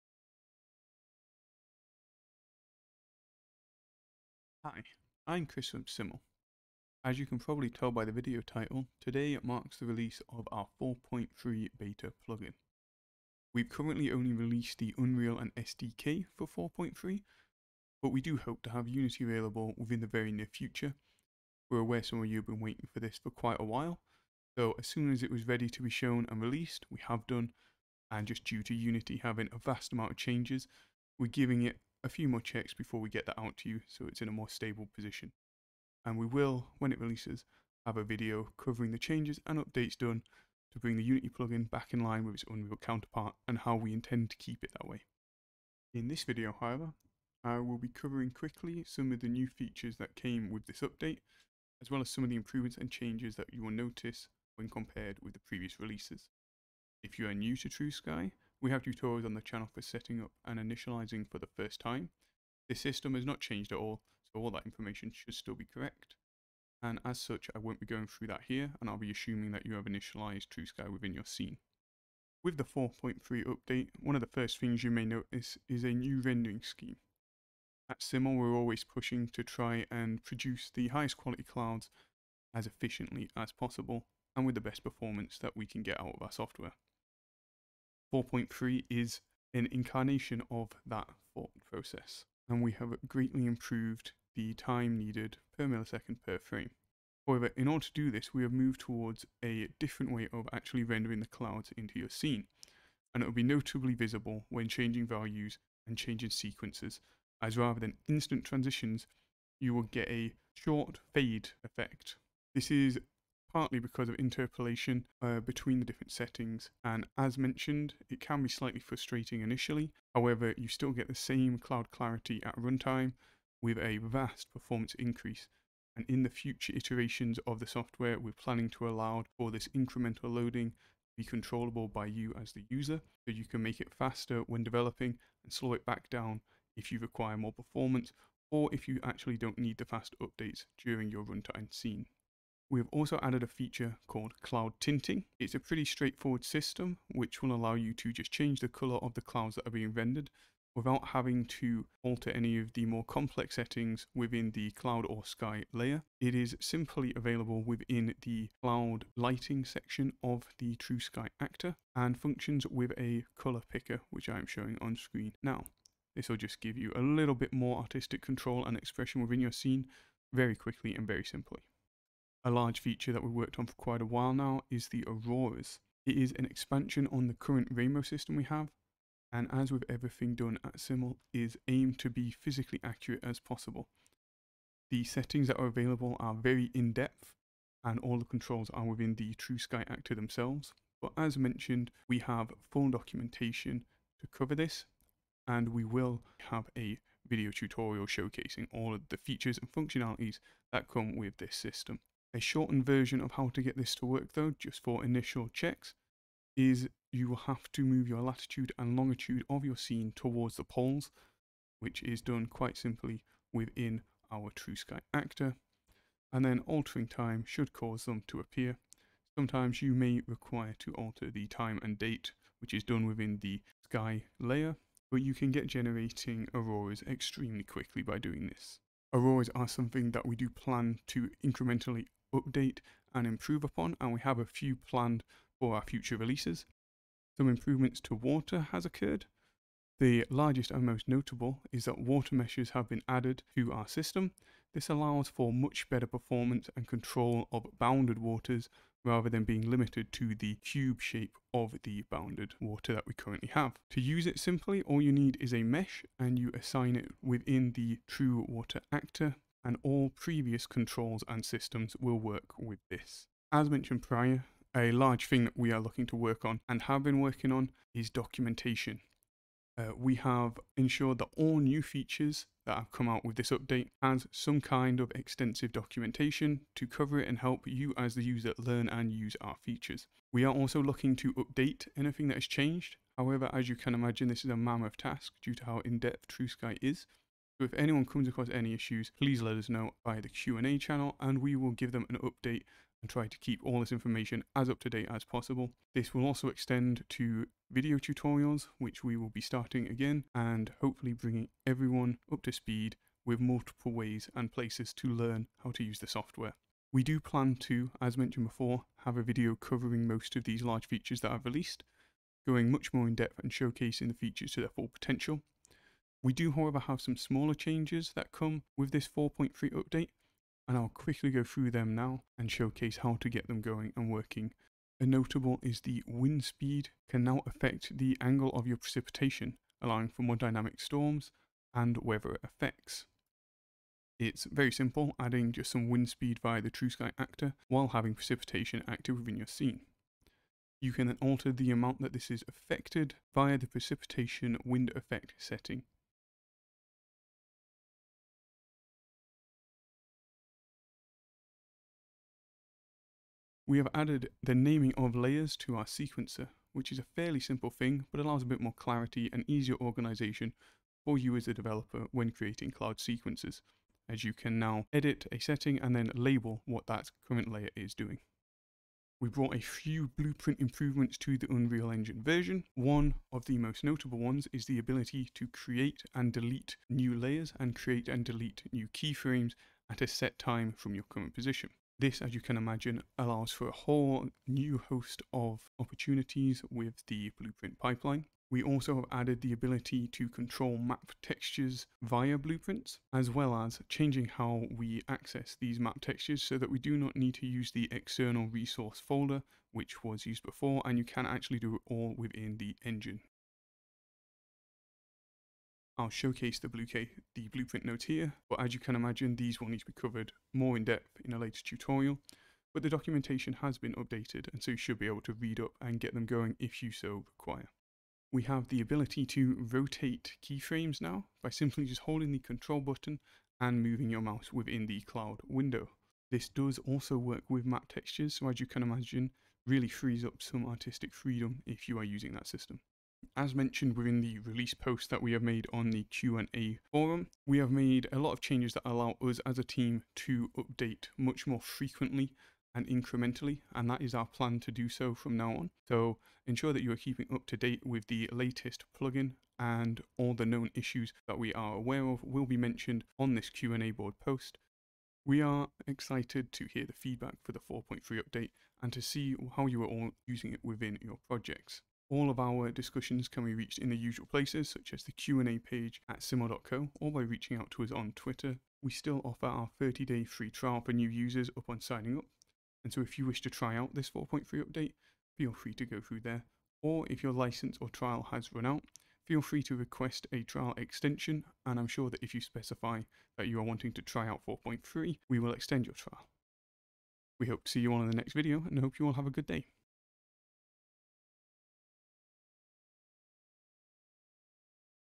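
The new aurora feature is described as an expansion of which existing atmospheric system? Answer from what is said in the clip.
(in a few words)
rainbow system.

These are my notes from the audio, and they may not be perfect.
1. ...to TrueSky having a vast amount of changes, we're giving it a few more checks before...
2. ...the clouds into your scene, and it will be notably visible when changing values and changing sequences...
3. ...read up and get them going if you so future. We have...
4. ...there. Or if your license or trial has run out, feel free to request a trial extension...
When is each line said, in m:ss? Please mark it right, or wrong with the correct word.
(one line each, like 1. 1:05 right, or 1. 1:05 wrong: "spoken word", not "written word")
1. 0:28 wrong: "Unity", not "TrueSky"
2. 1:41 right
3. 6:55 wrong: "require", not "future"
4. 7:56 right.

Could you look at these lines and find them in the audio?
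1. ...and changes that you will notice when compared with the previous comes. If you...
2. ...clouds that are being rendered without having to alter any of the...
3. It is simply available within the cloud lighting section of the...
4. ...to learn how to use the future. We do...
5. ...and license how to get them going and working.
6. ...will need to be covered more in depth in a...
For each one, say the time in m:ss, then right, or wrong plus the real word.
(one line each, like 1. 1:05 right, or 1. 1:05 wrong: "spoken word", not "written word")
1. 0:52 wrong: "releases", not "comes"
2. 2:29 right
3. 2:36 right
4. 5:04 wrong: "software", not "future"
5. 5:22 wrong: "showcase", not "license"
6. 6:49 right.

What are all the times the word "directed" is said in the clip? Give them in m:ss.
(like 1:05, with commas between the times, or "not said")
not said.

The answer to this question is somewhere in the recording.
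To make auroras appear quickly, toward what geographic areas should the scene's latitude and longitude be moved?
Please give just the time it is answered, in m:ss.
3:30.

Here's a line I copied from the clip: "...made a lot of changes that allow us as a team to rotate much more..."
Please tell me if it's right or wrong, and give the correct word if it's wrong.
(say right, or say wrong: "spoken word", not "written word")
wrong: "update", not "rotate".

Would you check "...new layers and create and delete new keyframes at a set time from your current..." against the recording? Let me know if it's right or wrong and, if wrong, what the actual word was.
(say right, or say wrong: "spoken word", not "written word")
right.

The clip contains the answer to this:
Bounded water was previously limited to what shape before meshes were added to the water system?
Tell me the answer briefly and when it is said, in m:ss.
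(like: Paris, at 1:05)
cube, at 4:10.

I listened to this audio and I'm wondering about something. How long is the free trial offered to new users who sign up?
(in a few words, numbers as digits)
30 days.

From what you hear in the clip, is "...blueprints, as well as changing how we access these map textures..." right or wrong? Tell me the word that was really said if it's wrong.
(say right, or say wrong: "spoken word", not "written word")
right.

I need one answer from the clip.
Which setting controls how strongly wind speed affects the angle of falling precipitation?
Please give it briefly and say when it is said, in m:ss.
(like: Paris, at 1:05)
precipitation wind effect, at 5:43.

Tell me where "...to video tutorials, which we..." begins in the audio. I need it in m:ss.
4:57.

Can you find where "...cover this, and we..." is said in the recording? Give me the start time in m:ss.
3:14.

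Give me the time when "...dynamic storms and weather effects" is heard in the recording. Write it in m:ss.
5:30.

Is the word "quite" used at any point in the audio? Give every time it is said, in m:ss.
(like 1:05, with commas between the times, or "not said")
0:23, 2:53, 3:32.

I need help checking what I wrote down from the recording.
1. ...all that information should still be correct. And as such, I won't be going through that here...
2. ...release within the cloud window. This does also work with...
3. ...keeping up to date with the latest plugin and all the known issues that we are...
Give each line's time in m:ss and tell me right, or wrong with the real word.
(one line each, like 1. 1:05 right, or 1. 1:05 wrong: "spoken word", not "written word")
1. 1:04 right
2. 7:04 wrong: "mouse", not "release"
3. 7:26 right.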